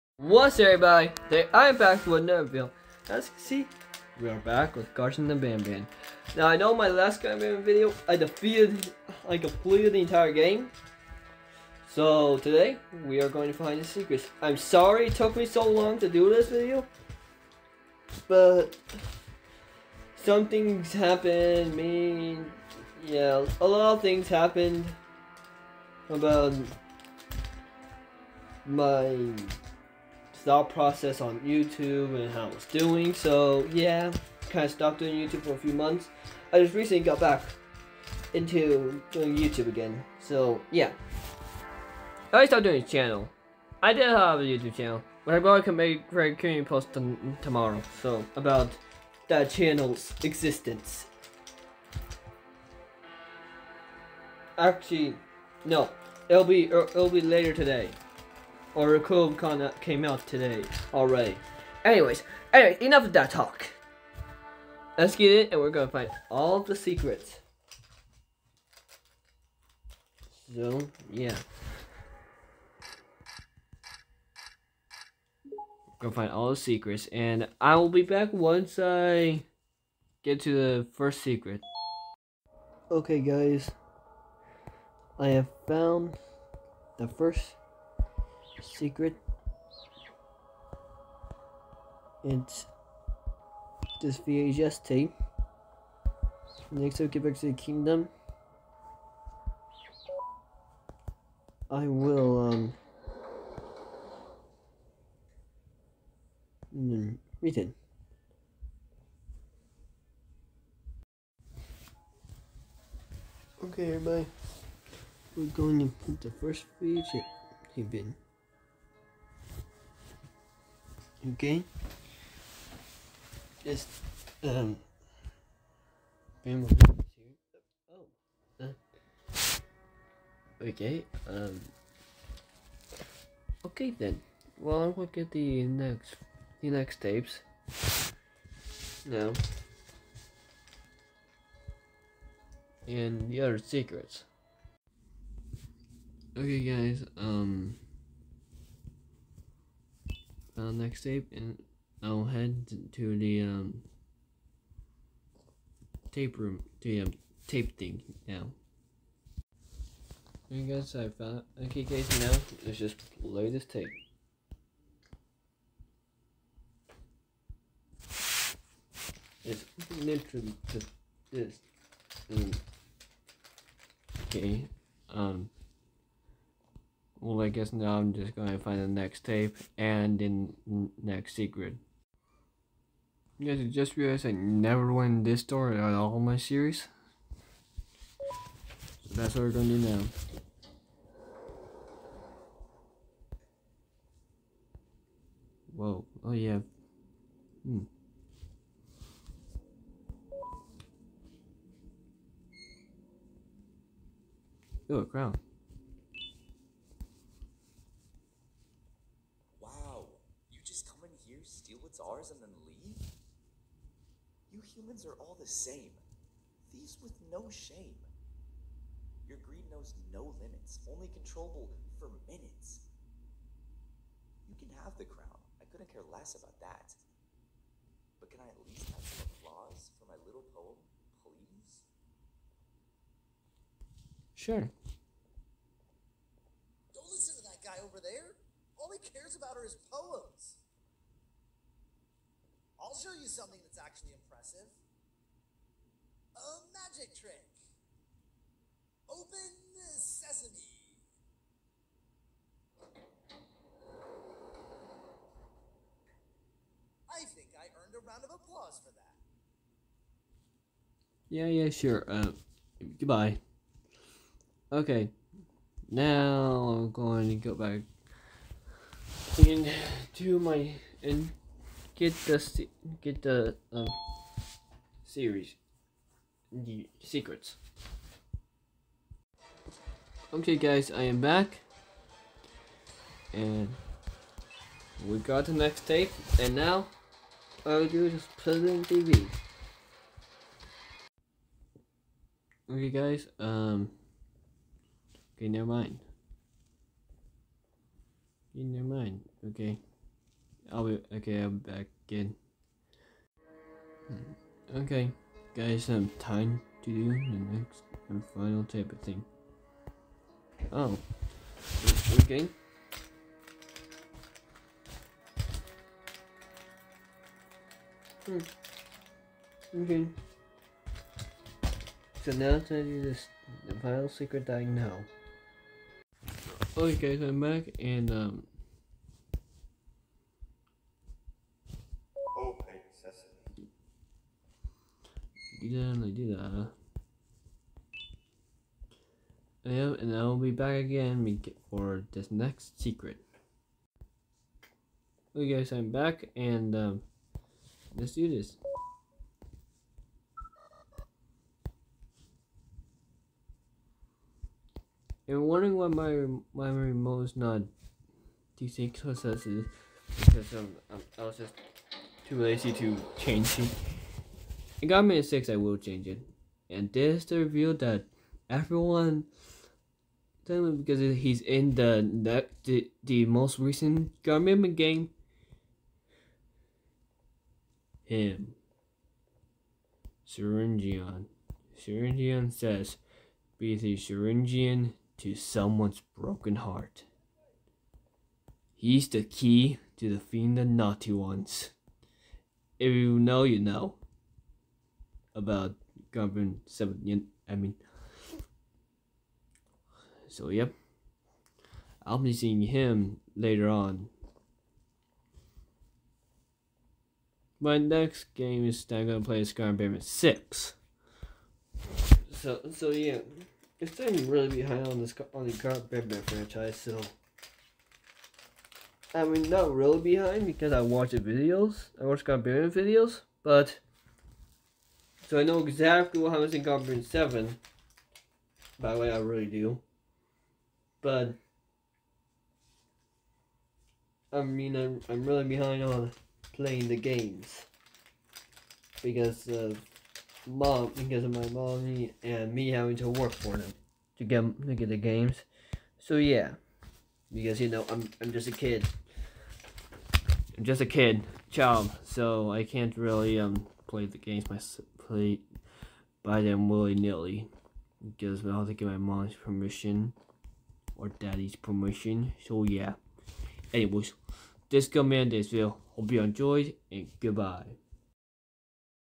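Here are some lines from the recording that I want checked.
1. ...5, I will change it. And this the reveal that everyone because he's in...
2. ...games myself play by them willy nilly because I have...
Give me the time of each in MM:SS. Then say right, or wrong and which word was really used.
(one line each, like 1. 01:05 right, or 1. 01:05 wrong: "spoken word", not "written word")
1. 06:05 wrong: "6", not "5"
2. 07:34 right.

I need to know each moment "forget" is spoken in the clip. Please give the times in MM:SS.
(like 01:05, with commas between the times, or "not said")
not said.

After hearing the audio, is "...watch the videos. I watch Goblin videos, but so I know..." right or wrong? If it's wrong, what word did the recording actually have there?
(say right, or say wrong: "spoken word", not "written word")
wrong: "Garbarian", not "Goblin".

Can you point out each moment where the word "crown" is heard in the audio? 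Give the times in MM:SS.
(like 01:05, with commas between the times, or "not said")
03:25, 03:45.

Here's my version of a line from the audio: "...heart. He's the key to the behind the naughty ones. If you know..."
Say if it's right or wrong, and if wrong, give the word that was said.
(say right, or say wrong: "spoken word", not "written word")
wrong: "fiend", not "behind".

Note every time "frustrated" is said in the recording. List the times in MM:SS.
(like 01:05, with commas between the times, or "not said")
not said.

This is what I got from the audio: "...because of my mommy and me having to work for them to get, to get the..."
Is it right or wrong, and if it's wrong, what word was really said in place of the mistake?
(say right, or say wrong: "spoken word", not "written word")
right.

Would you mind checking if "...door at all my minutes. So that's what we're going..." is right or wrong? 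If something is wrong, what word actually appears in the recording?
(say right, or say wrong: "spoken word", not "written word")
wrong: "series", not "minutes".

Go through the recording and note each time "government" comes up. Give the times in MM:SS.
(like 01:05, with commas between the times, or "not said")
06:14.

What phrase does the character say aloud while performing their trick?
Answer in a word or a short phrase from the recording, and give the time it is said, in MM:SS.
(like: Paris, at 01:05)
Open sesame, at 04:09.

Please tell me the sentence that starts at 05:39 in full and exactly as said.
Yeah, and I will be back again for this next secret.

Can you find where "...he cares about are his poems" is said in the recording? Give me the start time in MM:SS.
03:58.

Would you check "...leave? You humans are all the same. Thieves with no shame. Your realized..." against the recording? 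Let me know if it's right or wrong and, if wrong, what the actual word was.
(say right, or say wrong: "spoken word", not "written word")
wrong: "greed", not "realized".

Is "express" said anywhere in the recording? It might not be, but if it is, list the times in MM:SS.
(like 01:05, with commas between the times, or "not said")
not said.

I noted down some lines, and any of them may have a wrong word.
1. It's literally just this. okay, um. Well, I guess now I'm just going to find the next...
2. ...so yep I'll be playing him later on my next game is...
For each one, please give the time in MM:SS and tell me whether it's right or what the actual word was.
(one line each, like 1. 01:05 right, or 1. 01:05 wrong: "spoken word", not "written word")
1. 02:49 right
2. 06:40 wrong: "seeing", not "playing".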